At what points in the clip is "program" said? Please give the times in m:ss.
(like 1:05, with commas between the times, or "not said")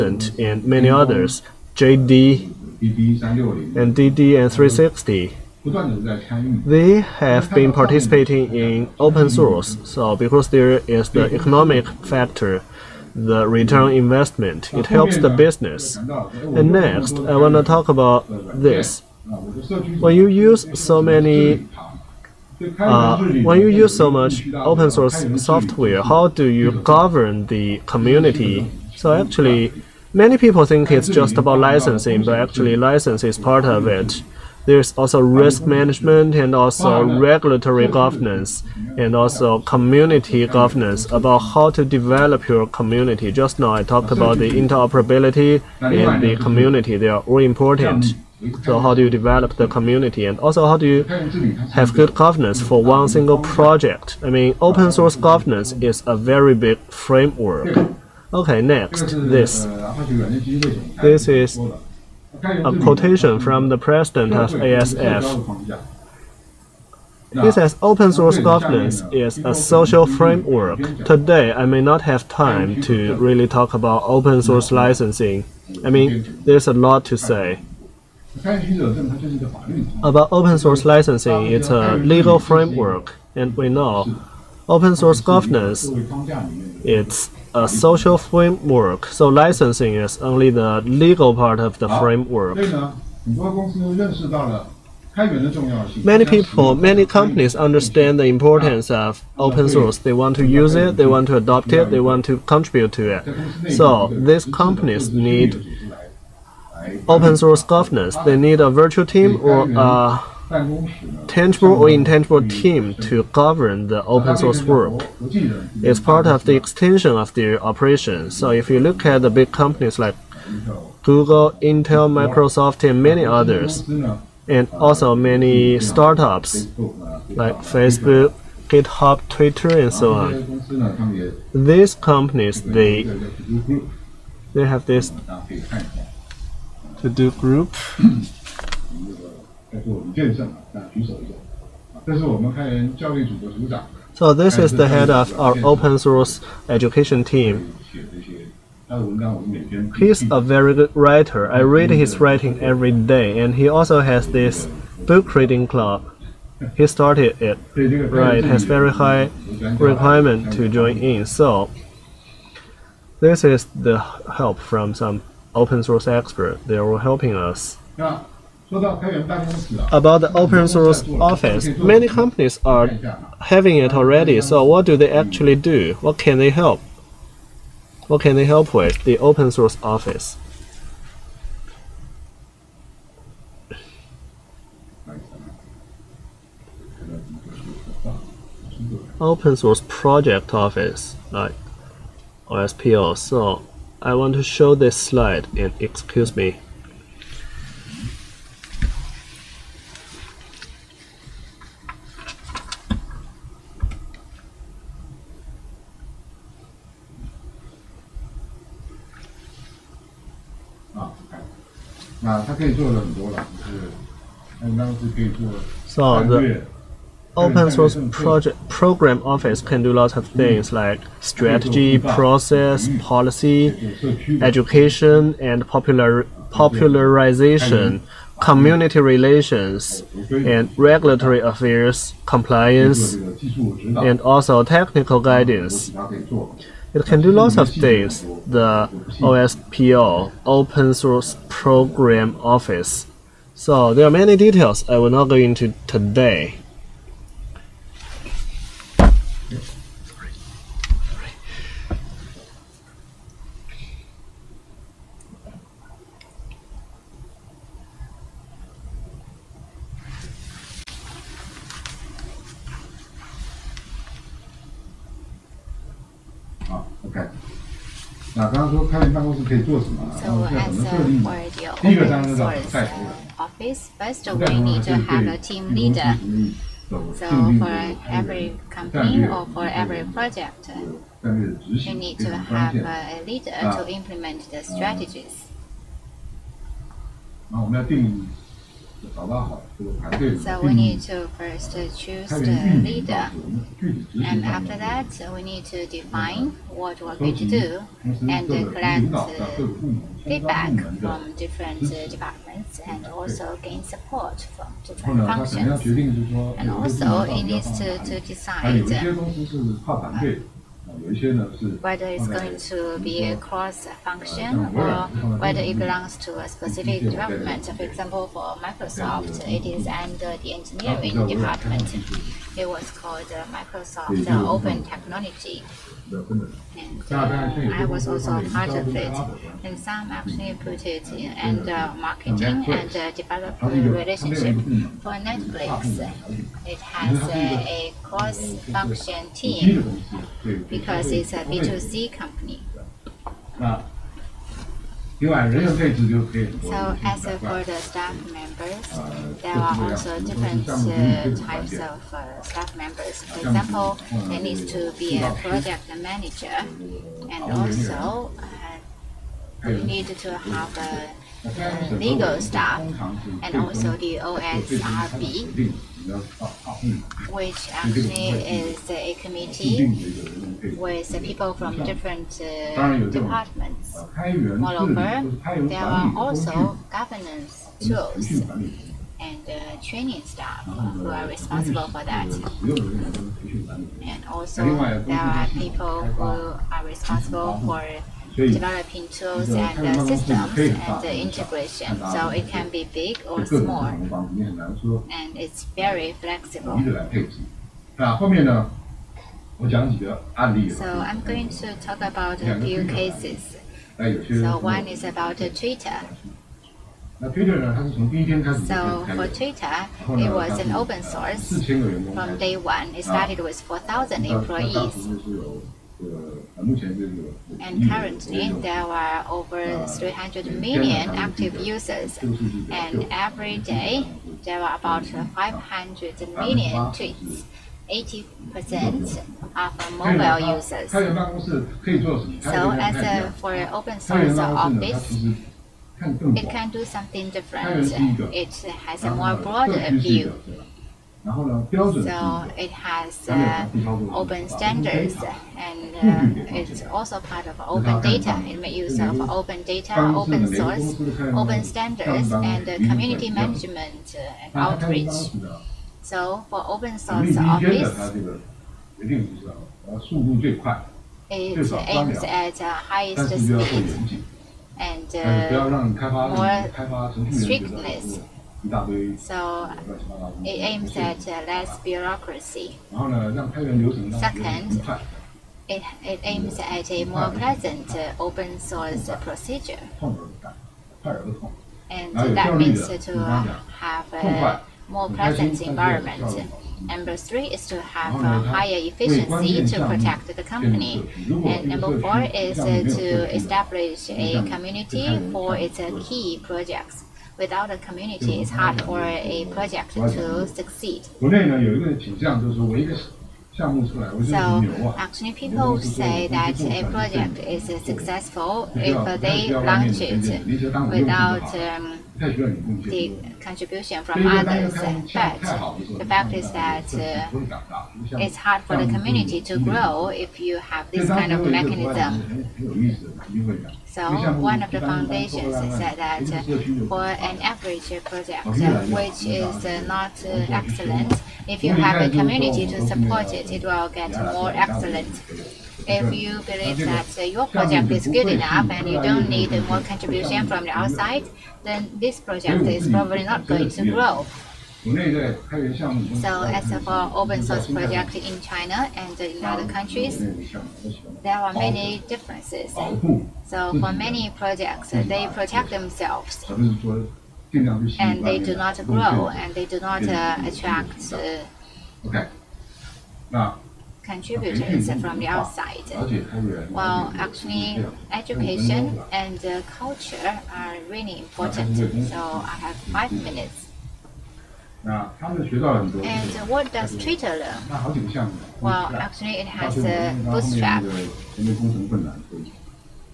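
3:38, 4:01.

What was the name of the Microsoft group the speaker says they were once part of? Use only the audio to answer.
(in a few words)
Microsoft Open Technology.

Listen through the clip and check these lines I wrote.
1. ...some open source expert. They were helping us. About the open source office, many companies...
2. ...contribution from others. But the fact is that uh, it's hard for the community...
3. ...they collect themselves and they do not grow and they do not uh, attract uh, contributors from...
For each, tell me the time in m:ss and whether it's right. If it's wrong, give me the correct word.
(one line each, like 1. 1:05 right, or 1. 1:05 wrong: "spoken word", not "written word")
1. 2:44 right
2. 8:33 right
3. 9:14 wrong: "protect", not "collect".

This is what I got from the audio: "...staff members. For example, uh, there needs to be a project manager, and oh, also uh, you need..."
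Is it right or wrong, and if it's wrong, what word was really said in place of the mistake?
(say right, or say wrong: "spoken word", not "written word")
right.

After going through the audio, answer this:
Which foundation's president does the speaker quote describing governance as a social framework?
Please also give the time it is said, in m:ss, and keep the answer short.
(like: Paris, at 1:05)
ASF, at 1:04.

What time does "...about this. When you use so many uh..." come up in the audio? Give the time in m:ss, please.
0:17.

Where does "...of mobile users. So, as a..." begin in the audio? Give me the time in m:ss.
7:09.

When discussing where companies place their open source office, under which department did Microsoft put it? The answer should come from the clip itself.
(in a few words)
engineering department.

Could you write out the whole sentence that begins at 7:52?
Second, it, it aims at a more pleasant uh, open source procedure.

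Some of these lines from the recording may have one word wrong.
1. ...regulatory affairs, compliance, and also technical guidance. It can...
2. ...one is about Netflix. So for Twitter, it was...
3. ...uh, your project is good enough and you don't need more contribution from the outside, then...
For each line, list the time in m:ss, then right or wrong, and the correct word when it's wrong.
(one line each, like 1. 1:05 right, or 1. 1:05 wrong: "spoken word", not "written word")
1. 3:50 right
2. 6:44 wrong: "Twitter", not "Netflix"
3. 8:57 right.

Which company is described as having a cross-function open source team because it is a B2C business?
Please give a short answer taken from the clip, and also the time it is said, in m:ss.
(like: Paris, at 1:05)
Netflix, at 5:35.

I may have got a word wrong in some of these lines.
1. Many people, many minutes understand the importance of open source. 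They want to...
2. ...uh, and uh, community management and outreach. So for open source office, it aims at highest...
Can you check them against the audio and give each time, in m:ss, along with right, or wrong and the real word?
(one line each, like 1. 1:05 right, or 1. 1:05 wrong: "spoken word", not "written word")
1. 1:36 wrong: "companies", not "minutes"
2. 7:32 right.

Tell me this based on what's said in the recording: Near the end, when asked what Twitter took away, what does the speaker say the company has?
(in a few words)
a bootstrap.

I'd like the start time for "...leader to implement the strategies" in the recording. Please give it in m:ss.
4:43.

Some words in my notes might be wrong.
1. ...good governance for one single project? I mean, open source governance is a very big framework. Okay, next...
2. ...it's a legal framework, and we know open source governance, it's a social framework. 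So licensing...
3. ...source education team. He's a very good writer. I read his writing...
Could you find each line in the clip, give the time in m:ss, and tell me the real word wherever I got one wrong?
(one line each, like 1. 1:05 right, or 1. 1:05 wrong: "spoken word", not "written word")
1. 0:51 right
2. 1:21 right
3. 2:25 right.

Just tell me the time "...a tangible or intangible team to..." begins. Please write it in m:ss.
1:49.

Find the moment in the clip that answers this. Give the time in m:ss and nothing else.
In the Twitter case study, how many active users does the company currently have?
6:59.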